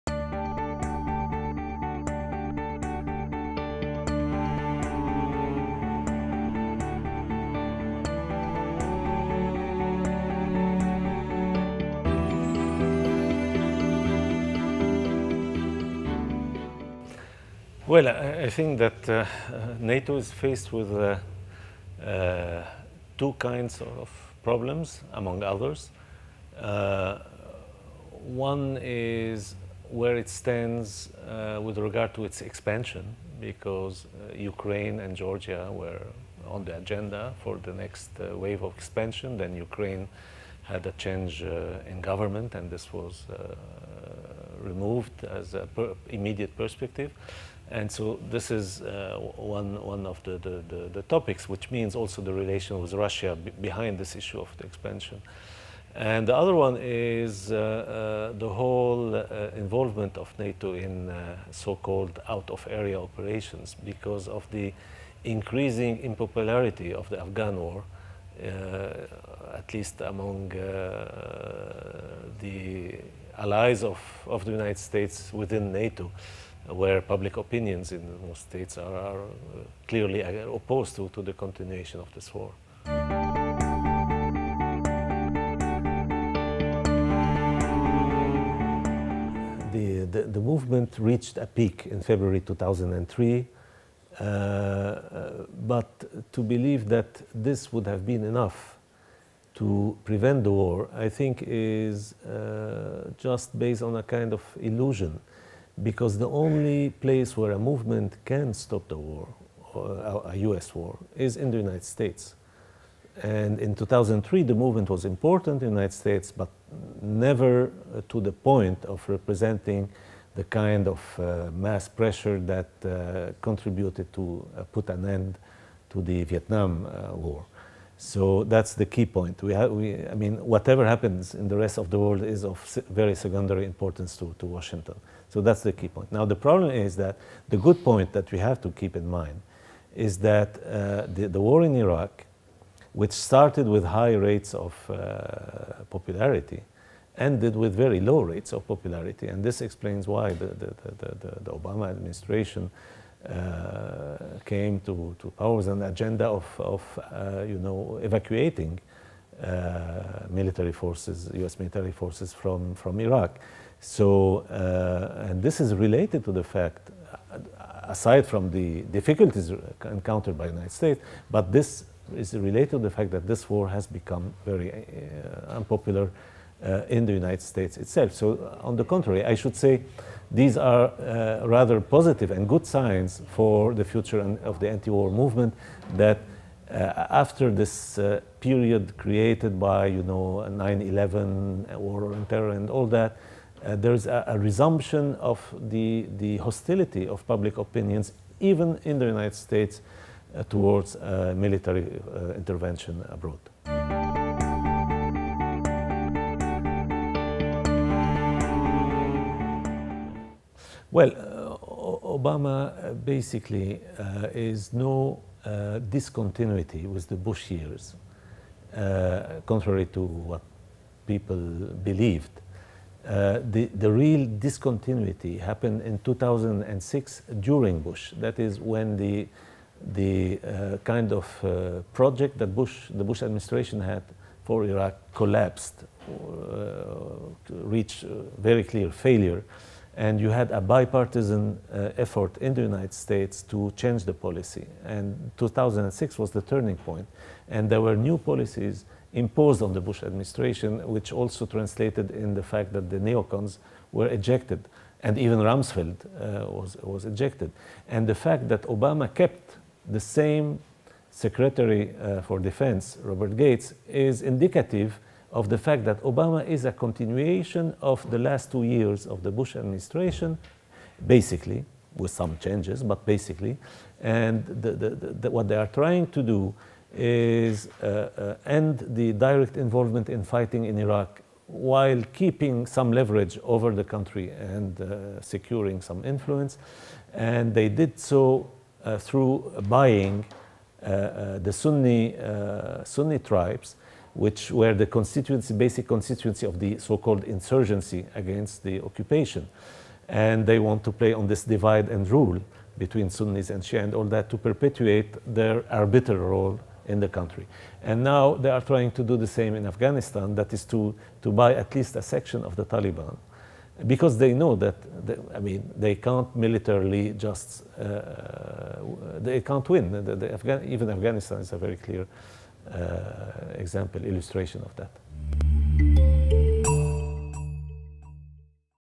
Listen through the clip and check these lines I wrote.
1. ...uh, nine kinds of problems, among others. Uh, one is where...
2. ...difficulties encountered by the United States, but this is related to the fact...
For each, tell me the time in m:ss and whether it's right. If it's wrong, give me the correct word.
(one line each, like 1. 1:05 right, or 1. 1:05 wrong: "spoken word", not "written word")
1. 0:22 wrong: "two", not "nine"
2. 2:48 right.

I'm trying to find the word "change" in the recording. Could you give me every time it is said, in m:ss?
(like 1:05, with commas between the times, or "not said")
0:40, 4:03, 4:32.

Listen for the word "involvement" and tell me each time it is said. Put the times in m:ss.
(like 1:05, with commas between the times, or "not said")
0:59, 4:39.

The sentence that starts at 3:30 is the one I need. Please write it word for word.
Well, uh, Obama basically uh, is no uh, discontinuity with the Bush years, uh, contrary to what people believed.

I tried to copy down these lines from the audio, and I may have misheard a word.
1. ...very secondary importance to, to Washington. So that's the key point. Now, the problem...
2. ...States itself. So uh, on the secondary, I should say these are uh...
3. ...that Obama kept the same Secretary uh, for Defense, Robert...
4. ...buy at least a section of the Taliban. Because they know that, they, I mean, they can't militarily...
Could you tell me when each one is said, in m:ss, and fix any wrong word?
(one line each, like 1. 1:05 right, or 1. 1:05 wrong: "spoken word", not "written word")
1. 2:12 right
2. 2:57 wrong: "contrary", not "secondary"
3. 4:18 right
4. 5:11 right.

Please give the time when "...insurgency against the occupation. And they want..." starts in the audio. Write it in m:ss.
4:57.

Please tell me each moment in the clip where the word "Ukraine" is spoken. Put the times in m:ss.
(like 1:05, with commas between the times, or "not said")
0:34, 0:39.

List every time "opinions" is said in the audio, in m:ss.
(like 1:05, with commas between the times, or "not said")
1:17, 3:17.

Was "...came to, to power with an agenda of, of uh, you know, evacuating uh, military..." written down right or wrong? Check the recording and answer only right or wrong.
right.